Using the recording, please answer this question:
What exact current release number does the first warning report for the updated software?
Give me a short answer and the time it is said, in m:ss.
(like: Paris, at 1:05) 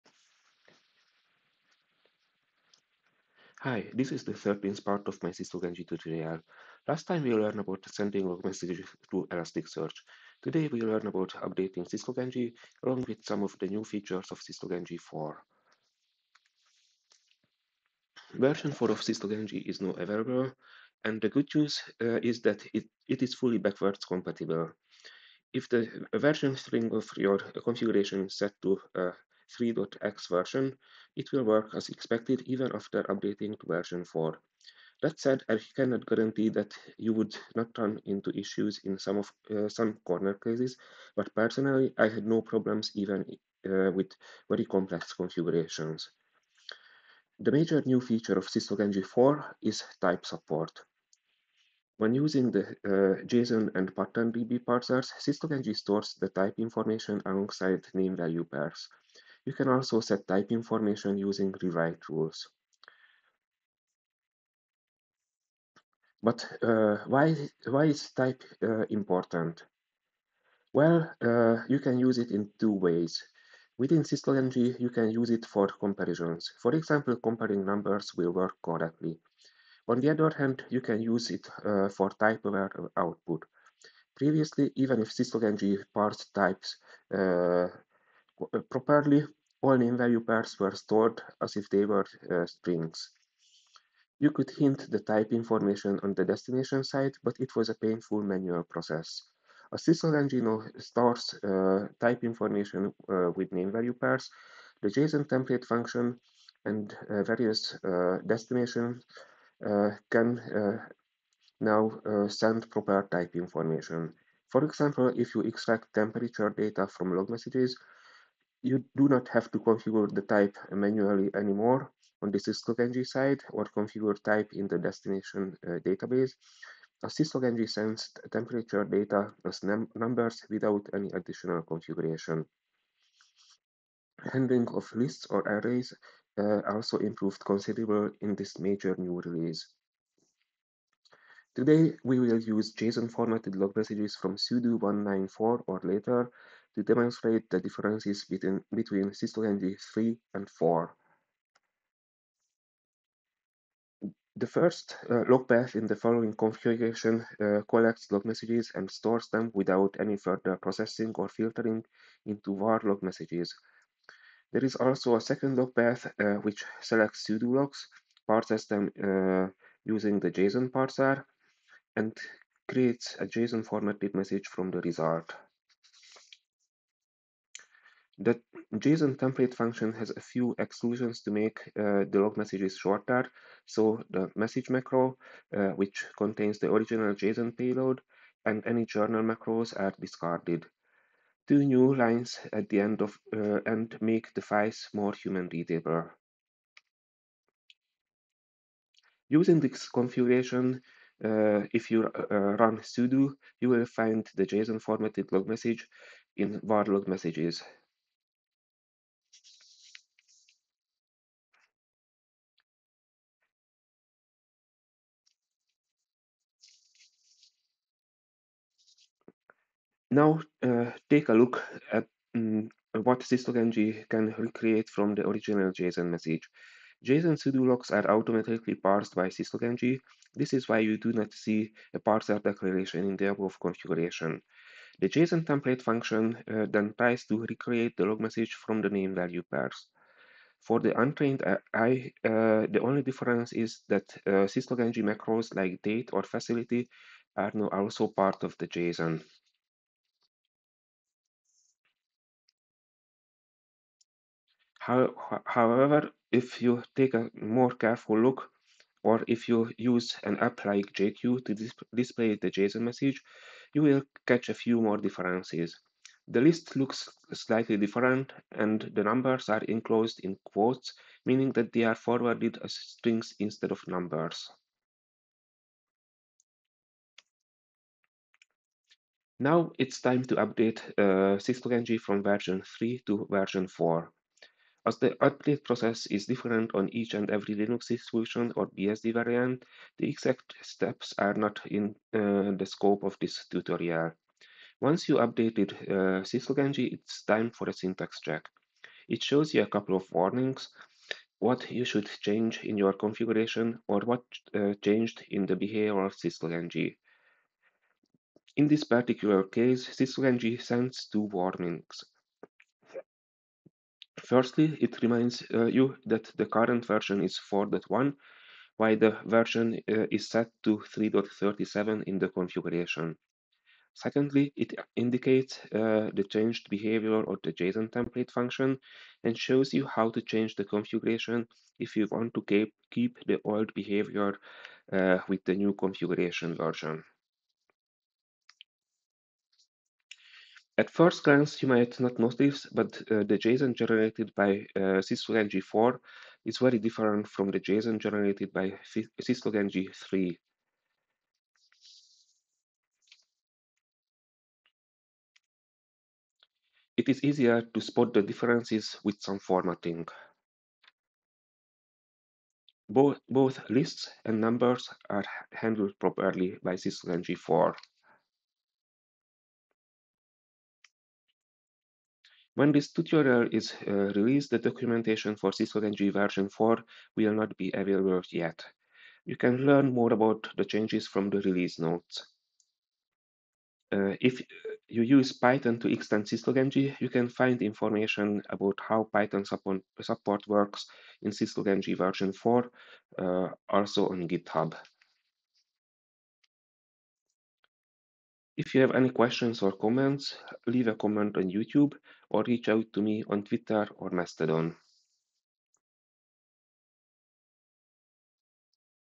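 4.1, at 5:17.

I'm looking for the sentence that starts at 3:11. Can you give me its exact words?
Two new lines at the end of uh, and make the files more human readable.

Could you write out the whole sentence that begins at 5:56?
It is easier to spot the differences with some formatting.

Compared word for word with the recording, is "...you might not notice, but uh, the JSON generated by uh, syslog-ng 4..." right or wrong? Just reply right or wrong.
right.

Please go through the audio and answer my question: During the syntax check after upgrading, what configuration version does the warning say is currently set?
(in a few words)
3.37.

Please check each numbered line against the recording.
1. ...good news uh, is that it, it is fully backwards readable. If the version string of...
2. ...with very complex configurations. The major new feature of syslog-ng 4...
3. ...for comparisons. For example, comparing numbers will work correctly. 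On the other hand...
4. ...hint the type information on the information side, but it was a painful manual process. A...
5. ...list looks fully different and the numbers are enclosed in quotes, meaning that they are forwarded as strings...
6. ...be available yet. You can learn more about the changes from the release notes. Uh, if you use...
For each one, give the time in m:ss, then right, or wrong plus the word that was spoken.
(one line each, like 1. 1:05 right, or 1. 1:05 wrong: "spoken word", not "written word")
1. 0:21 wrong: "compatible", not "readable"
2. 0:43 right
3. 1:15 right
4. 1:34 wrong: "destination", not "information"
5. 4:26 wrong: "slightly", not "fully"
6. 6:17 right.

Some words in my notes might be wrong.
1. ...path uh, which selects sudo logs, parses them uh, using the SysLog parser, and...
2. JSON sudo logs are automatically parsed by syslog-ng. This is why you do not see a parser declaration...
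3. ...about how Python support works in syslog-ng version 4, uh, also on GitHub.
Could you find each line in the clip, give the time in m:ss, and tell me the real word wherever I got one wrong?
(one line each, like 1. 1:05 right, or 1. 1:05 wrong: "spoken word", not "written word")
1. 2:45 wrong: "JSON", not "SysLog"
2. 3:47 right
3. 6:28 right.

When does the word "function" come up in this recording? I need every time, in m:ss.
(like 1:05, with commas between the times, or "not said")
1:45, 2:59, 3:55, 5:28.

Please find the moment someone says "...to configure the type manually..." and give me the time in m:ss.
1:59.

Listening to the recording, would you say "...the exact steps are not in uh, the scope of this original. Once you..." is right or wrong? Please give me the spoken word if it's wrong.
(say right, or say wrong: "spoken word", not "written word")
wrong: "tutorial", not "original".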